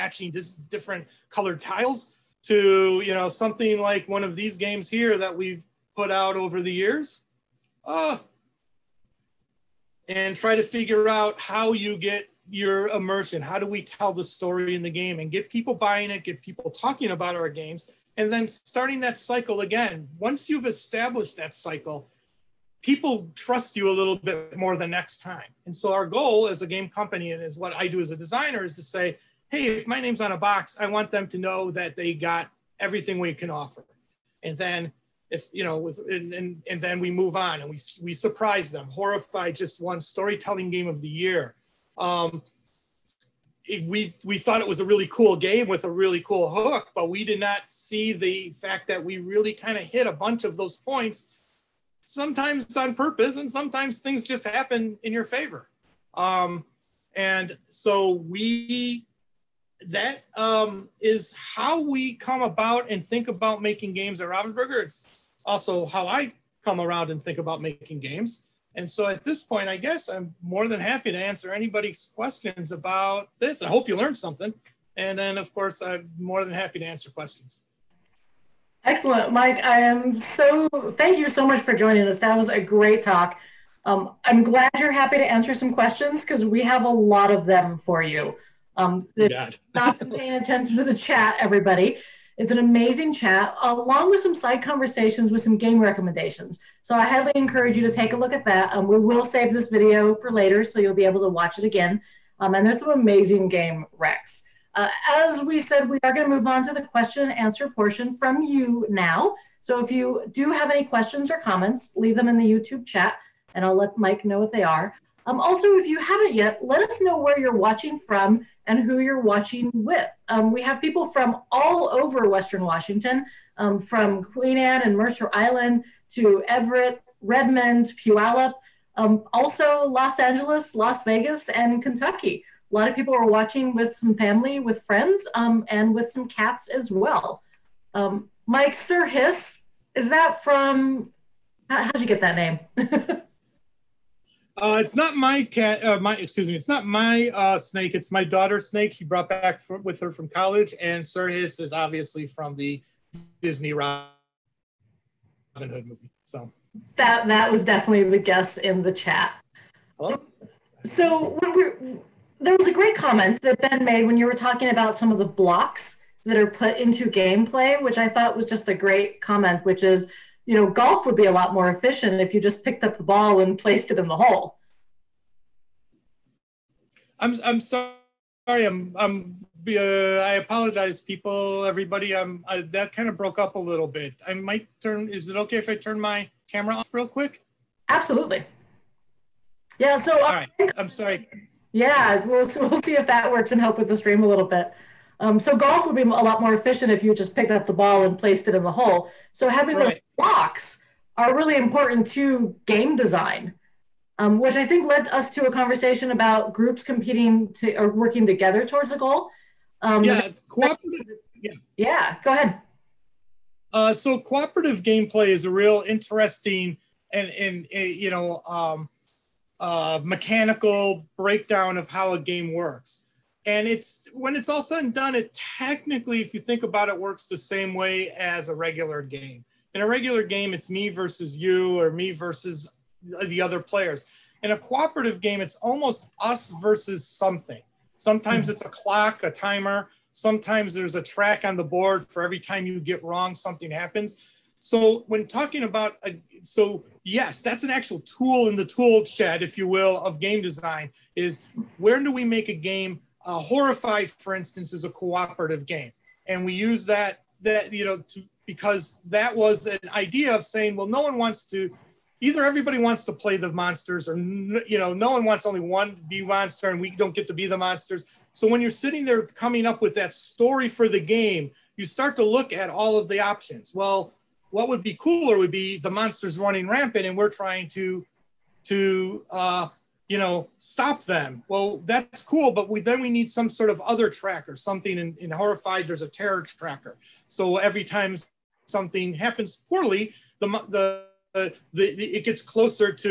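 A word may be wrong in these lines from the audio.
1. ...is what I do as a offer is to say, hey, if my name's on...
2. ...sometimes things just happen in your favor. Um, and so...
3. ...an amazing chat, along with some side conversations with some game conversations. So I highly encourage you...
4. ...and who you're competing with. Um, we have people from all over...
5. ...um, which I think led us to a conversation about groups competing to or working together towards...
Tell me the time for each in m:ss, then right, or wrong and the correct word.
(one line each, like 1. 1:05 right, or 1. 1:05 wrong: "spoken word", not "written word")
1. 0:27 wrong: "designer", not "offer"
2. 0:53 right
3. 1:32 wrong: "recommendations", not "conversations"
4. 1:58 wrong: "watching", not "competing"
5. 3:24 right.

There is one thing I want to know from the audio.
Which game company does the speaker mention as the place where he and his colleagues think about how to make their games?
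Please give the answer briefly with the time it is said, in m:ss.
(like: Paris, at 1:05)
Ravensburger, at 1:04.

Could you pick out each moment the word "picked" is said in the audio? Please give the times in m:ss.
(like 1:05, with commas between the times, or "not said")
2:52, 3:17.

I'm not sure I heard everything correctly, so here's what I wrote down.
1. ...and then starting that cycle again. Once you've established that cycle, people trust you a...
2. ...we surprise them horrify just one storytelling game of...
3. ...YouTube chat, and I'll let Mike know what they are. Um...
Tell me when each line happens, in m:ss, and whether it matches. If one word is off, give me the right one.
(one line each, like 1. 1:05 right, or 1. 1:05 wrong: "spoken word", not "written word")
1. 0:18 right
2. 0:38 right
3. 1:52 right.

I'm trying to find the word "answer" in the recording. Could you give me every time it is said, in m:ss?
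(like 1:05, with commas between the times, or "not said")
1:11, 1:16, 1:25, 1:47.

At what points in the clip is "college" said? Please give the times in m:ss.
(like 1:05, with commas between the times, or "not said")
2:30.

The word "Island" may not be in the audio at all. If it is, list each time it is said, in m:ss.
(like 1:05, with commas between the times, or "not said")
2:05.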